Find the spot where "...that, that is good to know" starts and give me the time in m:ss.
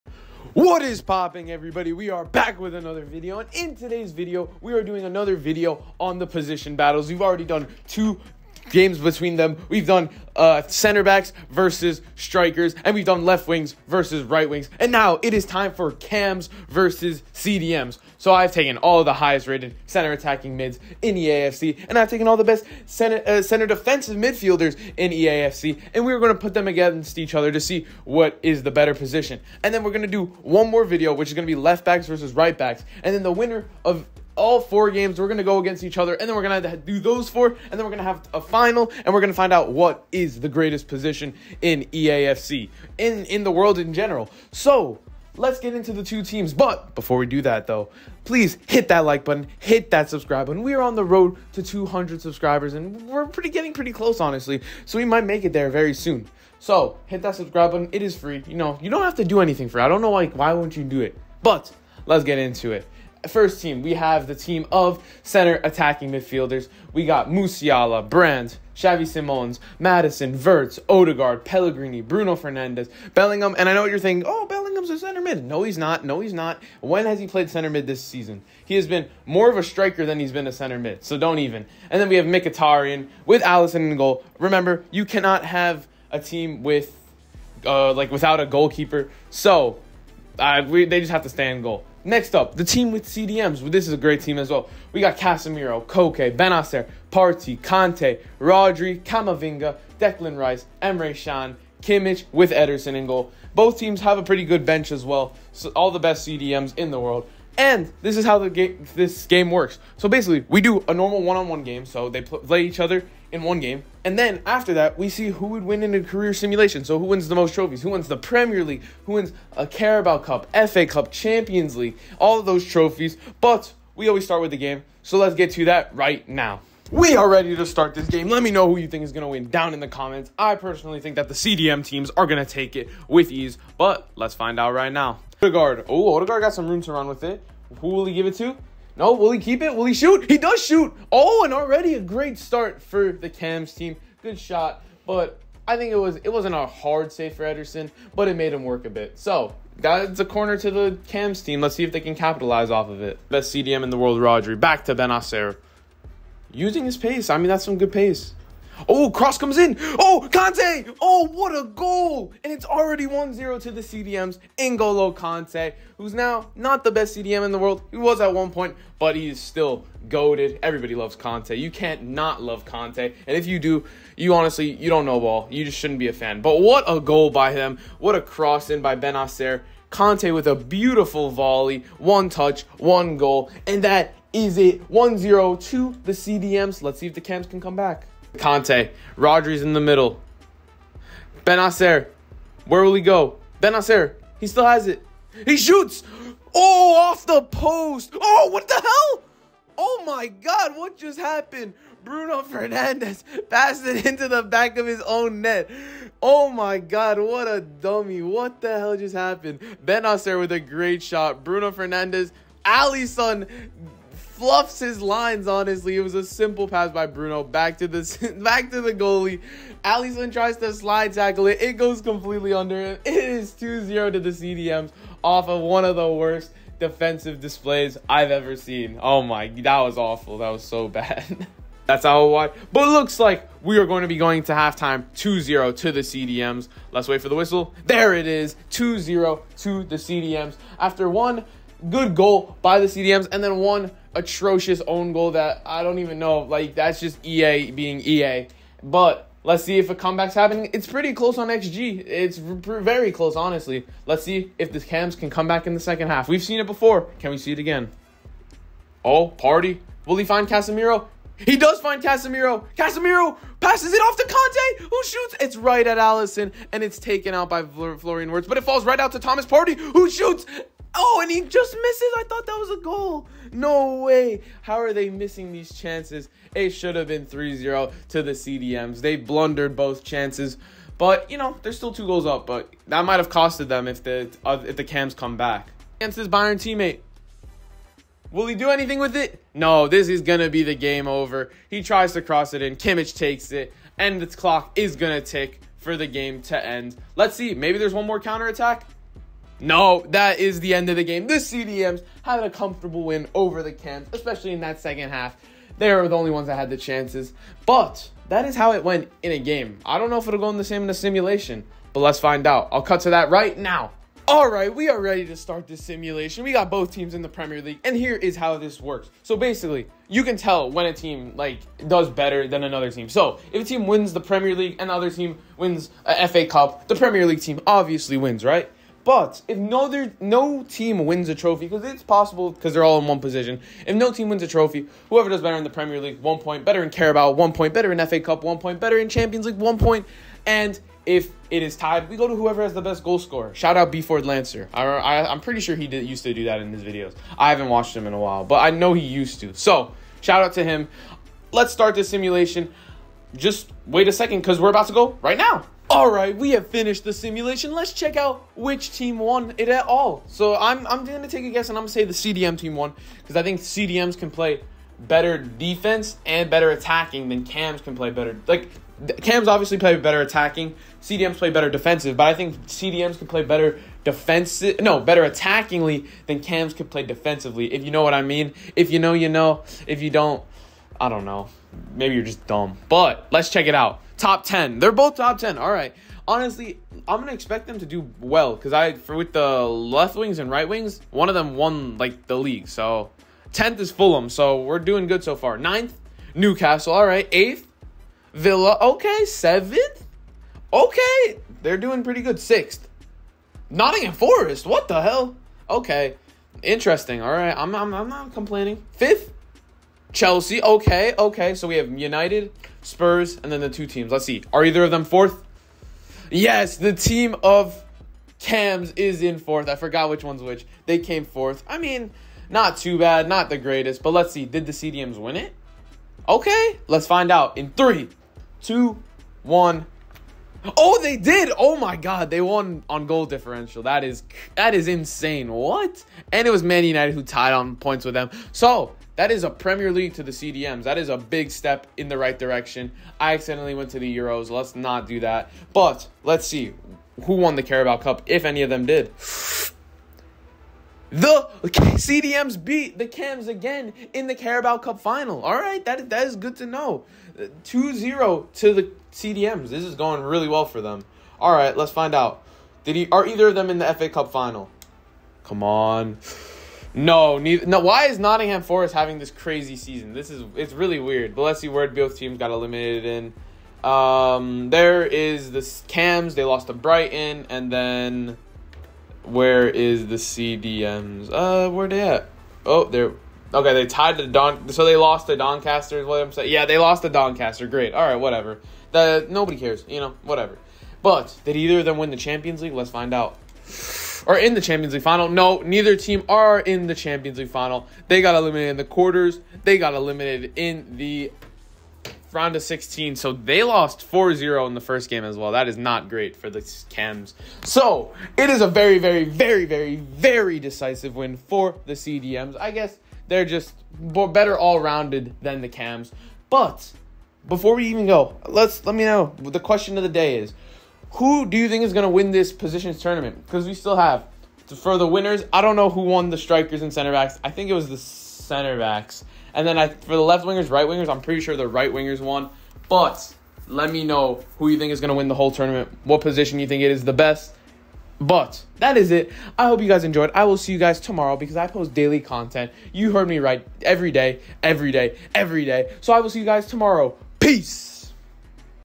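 7:35.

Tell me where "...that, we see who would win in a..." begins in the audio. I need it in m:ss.
1:54.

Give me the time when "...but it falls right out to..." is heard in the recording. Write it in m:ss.
4:28.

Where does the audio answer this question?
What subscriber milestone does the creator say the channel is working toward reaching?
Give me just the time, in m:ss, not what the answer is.
0:51.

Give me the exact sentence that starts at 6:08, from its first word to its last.
Like, cams obviously play better attacking.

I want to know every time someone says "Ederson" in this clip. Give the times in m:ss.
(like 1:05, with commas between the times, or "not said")
1:42, 2:27.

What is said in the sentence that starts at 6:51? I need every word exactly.
So we have United, Spurs, and then the two teams.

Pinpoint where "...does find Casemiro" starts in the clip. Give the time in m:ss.
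4:21.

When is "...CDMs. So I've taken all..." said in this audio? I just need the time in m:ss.
0:17.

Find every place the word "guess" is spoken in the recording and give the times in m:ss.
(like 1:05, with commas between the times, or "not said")
6:01, 8:32.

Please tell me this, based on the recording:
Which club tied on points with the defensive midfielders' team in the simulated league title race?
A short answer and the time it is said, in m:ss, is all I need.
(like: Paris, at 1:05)
Man United, at 7:16.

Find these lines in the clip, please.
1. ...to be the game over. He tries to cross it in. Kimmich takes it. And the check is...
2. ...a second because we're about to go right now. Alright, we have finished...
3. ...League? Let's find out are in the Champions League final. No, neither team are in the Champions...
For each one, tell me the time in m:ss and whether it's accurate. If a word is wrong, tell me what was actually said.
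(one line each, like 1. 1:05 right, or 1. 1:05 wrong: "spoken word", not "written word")
1. 4:50 wrong: "clock", not "check"
2. 5:54 right
3. 8:12 right.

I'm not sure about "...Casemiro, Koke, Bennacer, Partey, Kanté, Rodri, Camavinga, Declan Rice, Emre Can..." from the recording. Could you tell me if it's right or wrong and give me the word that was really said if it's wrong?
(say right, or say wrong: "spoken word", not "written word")
right.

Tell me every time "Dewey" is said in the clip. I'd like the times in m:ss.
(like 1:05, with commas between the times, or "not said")
not said.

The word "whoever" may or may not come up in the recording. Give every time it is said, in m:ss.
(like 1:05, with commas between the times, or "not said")
5:35, 5:42.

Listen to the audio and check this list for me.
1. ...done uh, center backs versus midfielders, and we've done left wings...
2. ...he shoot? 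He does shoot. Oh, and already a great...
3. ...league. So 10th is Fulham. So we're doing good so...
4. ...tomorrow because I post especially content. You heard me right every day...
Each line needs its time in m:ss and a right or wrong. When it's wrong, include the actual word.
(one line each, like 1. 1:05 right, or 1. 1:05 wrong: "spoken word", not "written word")
1. 0:09 wrong: "strikers", not "midfielders"
2. 2:19 right
3. 6:32 right
4. 9:00 wrong: "daily", not "especially".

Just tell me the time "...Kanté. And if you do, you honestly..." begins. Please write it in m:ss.
2:52.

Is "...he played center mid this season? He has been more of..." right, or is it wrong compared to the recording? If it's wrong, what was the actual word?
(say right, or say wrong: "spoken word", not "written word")
right.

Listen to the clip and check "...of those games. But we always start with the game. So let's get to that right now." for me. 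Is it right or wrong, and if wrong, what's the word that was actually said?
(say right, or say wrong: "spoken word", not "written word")
wrong: "trophies", not "games".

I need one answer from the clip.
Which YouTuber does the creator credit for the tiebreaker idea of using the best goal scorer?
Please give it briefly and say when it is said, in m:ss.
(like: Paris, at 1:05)
B Ford Lancer, at 5:43.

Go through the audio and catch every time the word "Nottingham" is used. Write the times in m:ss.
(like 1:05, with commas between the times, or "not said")
6:43, 7:48.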